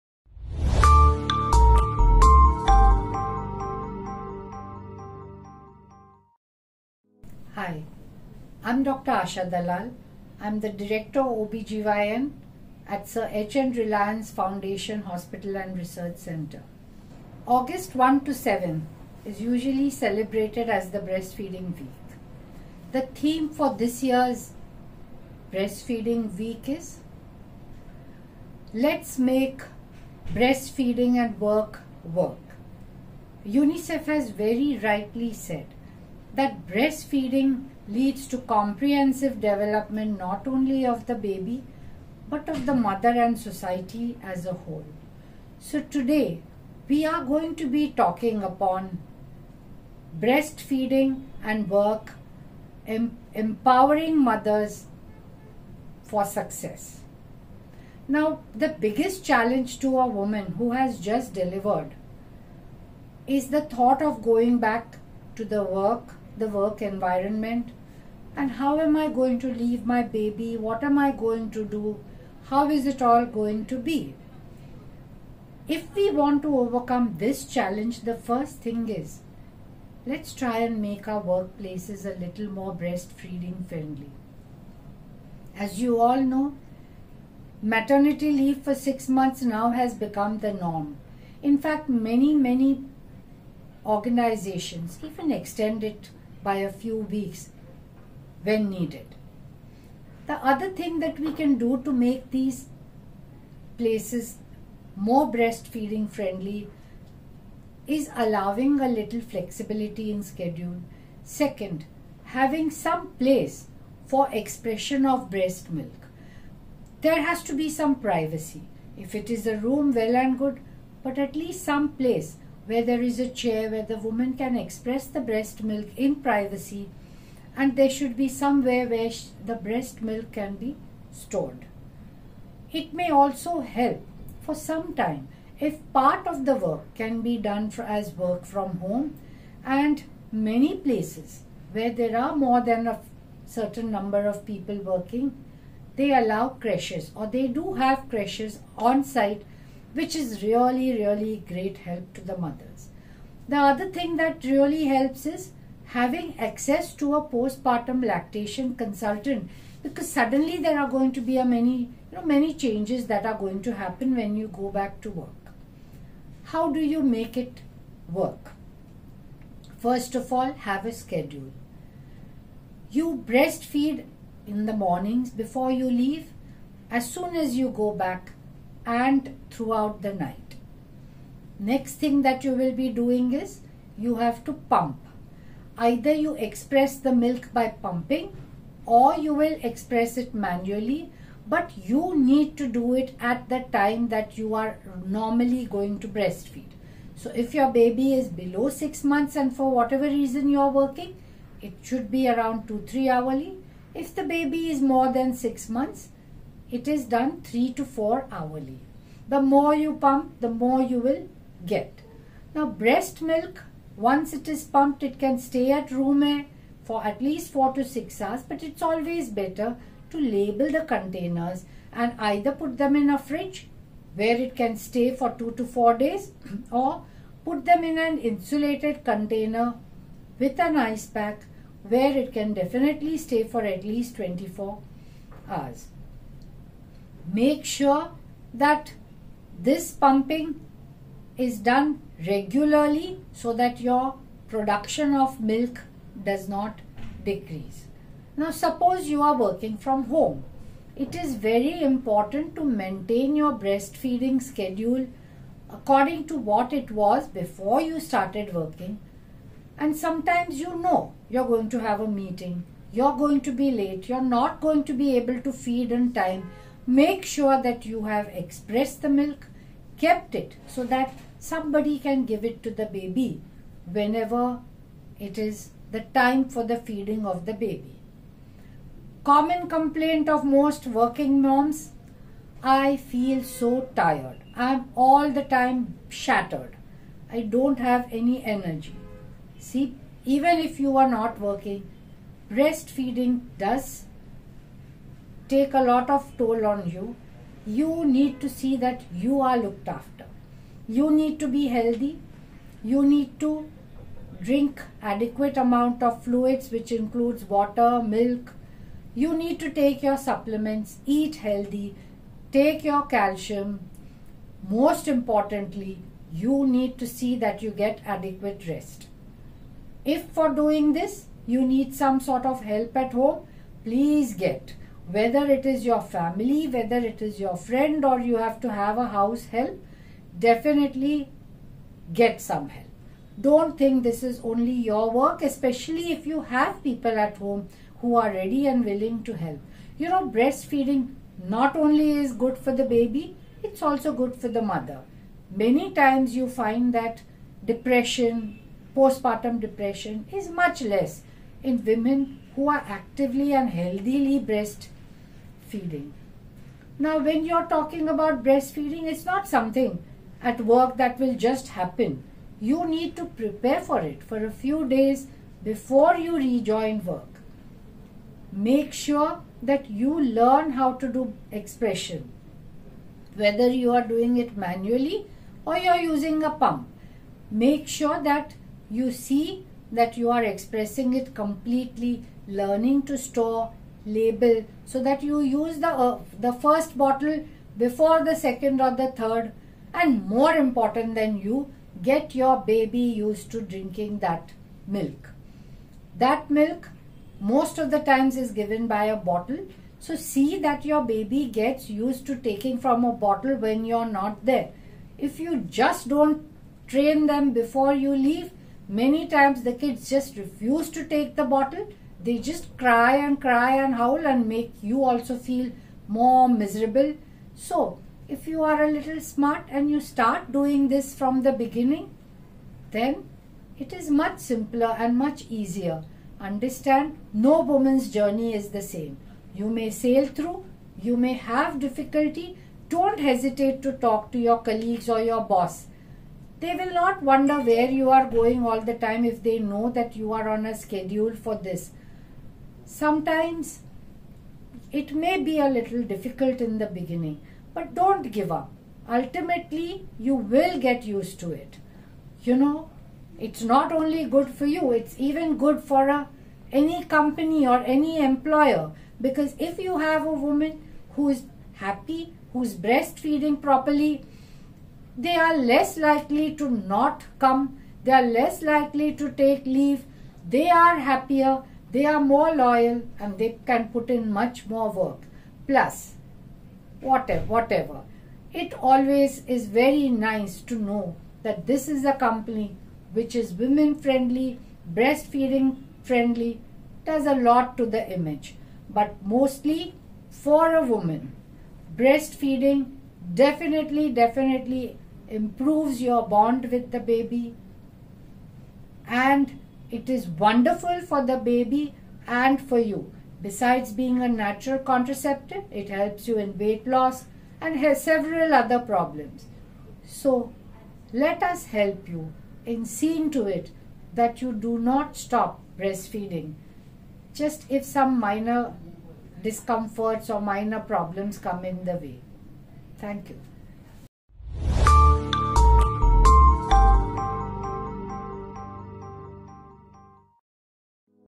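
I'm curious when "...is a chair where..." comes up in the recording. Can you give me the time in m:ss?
2:03.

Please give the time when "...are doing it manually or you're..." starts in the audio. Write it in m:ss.
6:13.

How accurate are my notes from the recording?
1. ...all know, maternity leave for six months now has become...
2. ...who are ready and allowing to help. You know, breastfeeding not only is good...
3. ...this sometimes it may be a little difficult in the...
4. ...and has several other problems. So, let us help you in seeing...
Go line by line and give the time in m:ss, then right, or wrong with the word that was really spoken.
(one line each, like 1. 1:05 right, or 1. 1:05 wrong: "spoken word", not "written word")
1. 1:25 right
2. 5:38 wrong: "willing", not "allowing"
3. 7:21 right
4. 8:27 right.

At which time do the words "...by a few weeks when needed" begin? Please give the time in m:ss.
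1:36.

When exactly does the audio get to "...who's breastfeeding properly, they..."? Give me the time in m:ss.
7:42.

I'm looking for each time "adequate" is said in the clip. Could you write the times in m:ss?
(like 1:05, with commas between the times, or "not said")
5:05, 5:18.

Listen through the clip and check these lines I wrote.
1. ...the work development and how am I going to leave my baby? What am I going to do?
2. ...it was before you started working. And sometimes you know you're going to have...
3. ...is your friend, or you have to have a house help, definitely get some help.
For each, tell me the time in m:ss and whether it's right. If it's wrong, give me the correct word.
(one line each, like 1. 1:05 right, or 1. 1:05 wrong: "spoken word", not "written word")
1. 1:06 wrong: "environment", not "development"
2. 4:16 right
3. 5:27 right.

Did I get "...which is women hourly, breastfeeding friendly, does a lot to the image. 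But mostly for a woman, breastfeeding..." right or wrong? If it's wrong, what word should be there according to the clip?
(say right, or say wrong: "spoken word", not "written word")
wrong: "friendly", not "hourly".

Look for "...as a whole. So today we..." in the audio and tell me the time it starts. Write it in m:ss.
0:44.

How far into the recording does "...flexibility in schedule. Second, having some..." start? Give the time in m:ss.
1:49.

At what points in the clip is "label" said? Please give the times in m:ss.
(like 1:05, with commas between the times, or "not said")
3:40, 6:24.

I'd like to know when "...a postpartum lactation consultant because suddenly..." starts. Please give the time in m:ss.
2:37.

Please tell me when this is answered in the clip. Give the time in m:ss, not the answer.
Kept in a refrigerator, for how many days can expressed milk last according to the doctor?
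3:45.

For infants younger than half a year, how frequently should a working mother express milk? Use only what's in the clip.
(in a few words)
2-3 hourly.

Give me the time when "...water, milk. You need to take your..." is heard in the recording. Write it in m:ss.
5:07.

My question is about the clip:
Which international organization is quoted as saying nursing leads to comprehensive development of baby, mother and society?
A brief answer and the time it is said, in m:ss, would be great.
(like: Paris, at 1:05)
UNICEF, at 0:33.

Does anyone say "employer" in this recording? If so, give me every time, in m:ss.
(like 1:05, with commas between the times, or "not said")
7:38.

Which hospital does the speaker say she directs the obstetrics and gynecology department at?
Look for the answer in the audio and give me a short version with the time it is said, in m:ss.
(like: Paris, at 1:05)
Sir H.N. 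Reliance Foundation Hospital, at 0:13.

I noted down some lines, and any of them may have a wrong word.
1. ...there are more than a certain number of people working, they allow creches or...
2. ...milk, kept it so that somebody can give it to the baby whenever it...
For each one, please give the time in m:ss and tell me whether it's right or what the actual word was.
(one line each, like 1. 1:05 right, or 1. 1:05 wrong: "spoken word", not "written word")
1. 2:21 right
2. 4:29 right.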